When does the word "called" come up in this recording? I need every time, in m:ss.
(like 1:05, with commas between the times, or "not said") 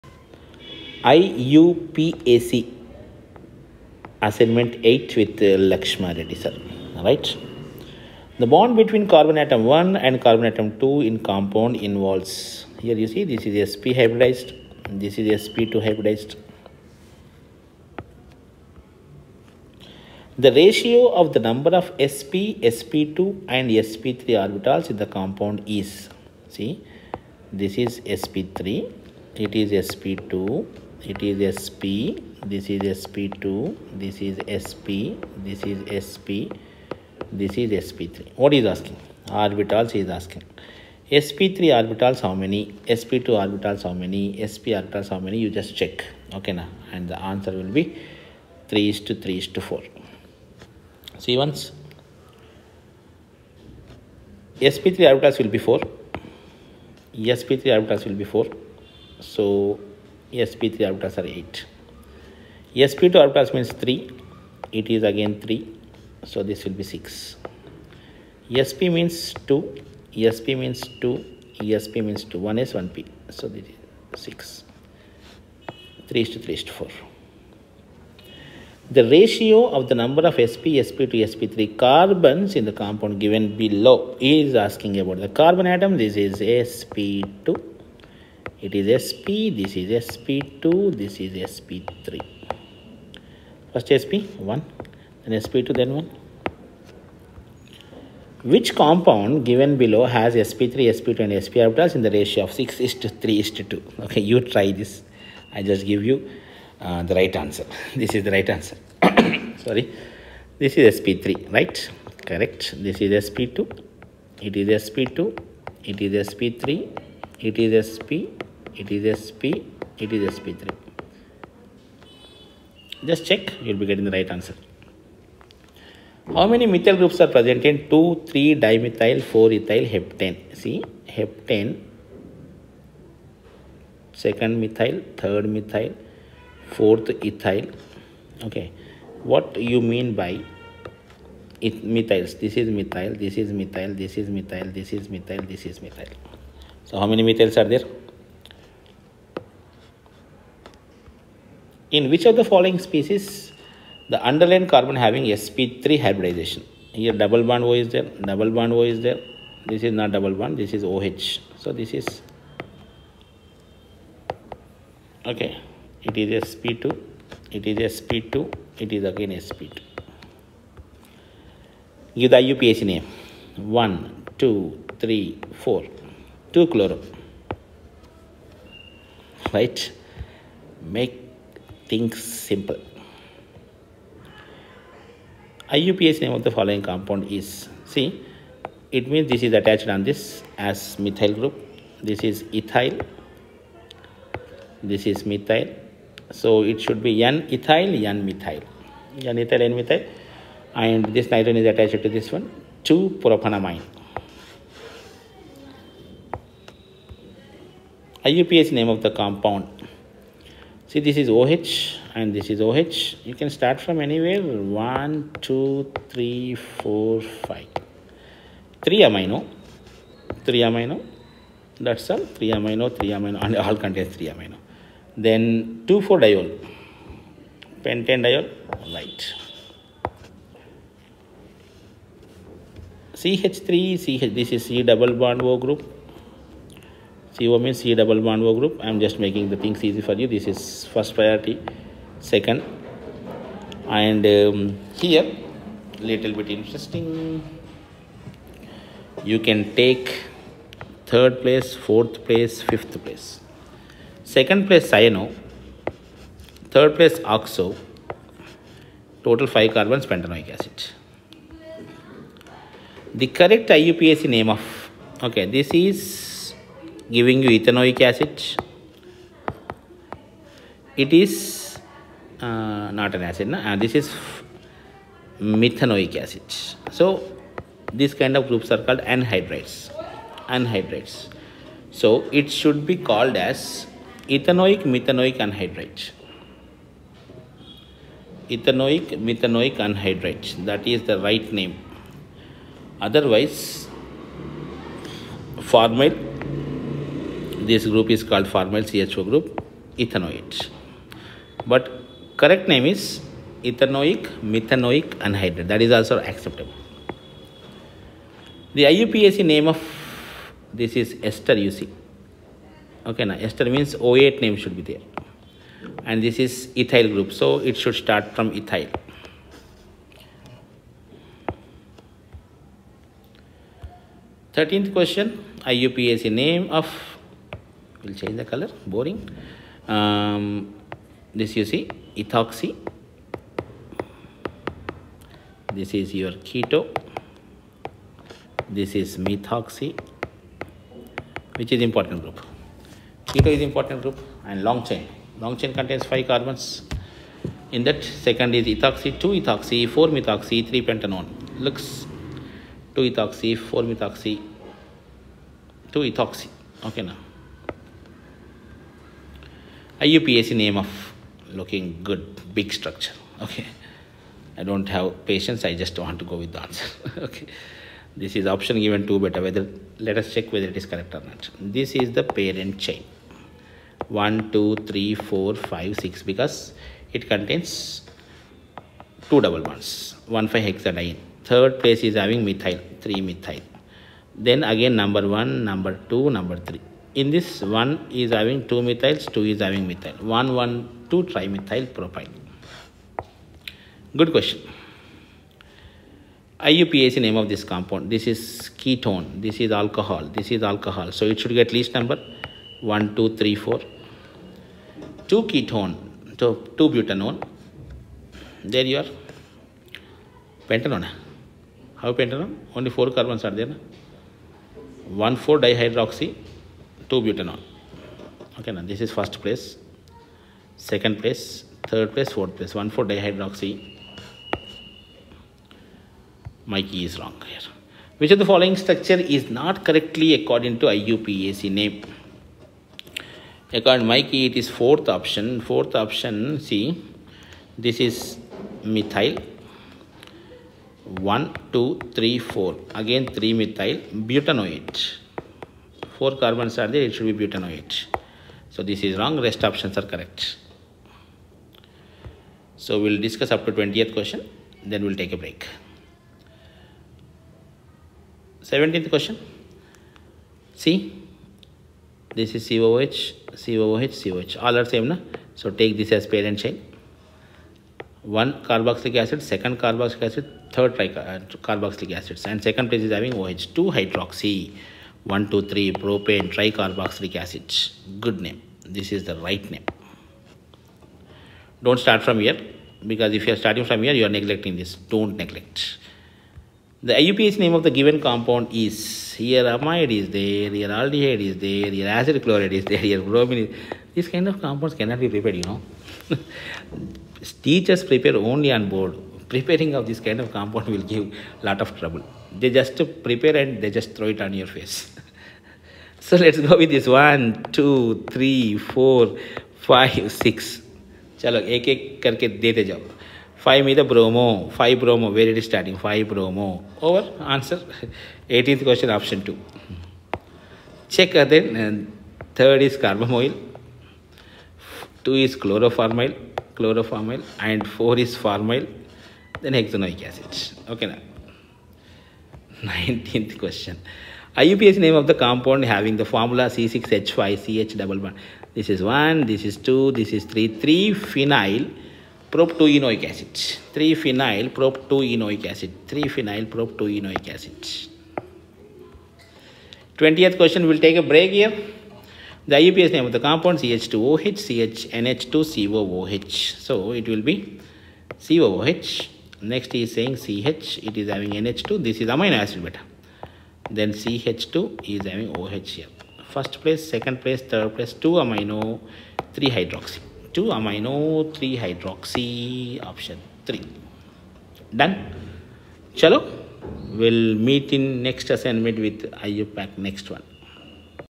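4:38, 4:43, 4:58.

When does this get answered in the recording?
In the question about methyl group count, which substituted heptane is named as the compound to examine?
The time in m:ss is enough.
2:07.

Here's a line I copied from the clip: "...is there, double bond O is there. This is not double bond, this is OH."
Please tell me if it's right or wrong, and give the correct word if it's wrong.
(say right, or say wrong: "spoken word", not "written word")
right.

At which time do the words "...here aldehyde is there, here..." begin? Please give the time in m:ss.
8:10.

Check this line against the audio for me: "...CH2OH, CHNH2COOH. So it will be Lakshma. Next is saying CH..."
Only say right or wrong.
wrong.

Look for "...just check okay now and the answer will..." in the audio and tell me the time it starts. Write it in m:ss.
0:45.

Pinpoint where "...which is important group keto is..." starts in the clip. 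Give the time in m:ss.
5:41.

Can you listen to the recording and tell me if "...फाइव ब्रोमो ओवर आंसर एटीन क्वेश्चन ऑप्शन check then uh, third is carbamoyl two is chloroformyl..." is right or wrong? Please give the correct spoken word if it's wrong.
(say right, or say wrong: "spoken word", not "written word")
right.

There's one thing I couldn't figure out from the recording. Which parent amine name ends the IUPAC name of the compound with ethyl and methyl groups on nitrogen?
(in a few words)
2-propanamine.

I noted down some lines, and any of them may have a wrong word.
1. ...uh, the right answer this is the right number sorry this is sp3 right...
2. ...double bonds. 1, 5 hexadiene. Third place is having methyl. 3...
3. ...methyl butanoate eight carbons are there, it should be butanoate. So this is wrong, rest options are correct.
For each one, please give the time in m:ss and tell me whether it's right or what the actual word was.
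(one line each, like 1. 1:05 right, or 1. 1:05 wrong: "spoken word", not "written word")
1. 1:46 wrong: "answer", not "number"
2. 6:19 right
3. 7:23 wrong: "four", not "eight".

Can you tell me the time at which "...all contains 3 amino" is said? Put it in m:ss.
3:43.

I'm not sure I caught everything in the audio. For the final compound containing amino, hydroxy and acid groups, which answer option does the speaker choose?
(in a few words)
option 3.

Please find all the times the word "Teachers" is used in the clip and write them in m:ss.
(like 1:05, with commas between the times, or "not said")
8:17.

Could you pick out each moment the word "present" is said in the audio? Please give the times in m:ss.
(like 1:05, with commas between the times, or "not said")
2:07.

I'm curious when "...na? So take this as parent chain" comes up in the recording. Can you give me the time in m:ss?
7:45.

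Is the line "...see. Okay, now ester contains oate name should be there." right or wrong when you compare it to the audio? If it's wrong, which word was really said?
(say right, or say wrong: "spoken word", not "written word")
wrong: "means", not "contains".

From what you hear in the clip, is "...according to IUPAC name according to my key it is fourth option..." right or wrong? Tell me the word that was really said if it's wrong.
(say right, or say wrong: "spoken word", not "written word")
right.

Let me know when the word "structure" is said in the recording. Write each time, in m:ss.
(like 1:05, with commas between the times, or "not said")
6:02, 7:08.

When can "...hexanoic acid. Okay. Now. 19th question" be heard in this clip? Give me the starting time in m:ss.
8:49.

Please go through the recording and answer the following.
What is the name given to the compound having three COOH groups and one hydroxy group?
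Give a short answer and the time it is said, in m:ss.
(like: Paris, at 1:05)
2-hydroxy 1,2,3 propane tricarboxylic acid, at 7:55.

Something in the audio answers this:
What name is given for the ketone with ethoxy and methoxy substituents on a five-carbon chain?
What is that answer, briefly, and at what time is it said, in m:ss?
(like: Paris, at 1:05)
2 ethoxy 4 methoxy 3 pentanone, at 5:49.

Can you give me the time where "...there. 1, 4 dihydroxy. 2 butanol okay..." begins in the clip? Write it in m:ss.
6:53.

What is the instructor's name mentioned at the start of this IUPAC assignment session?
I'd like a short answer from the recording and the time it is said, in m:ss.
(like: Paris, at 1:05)
Lakshma Reddy, at 0:05.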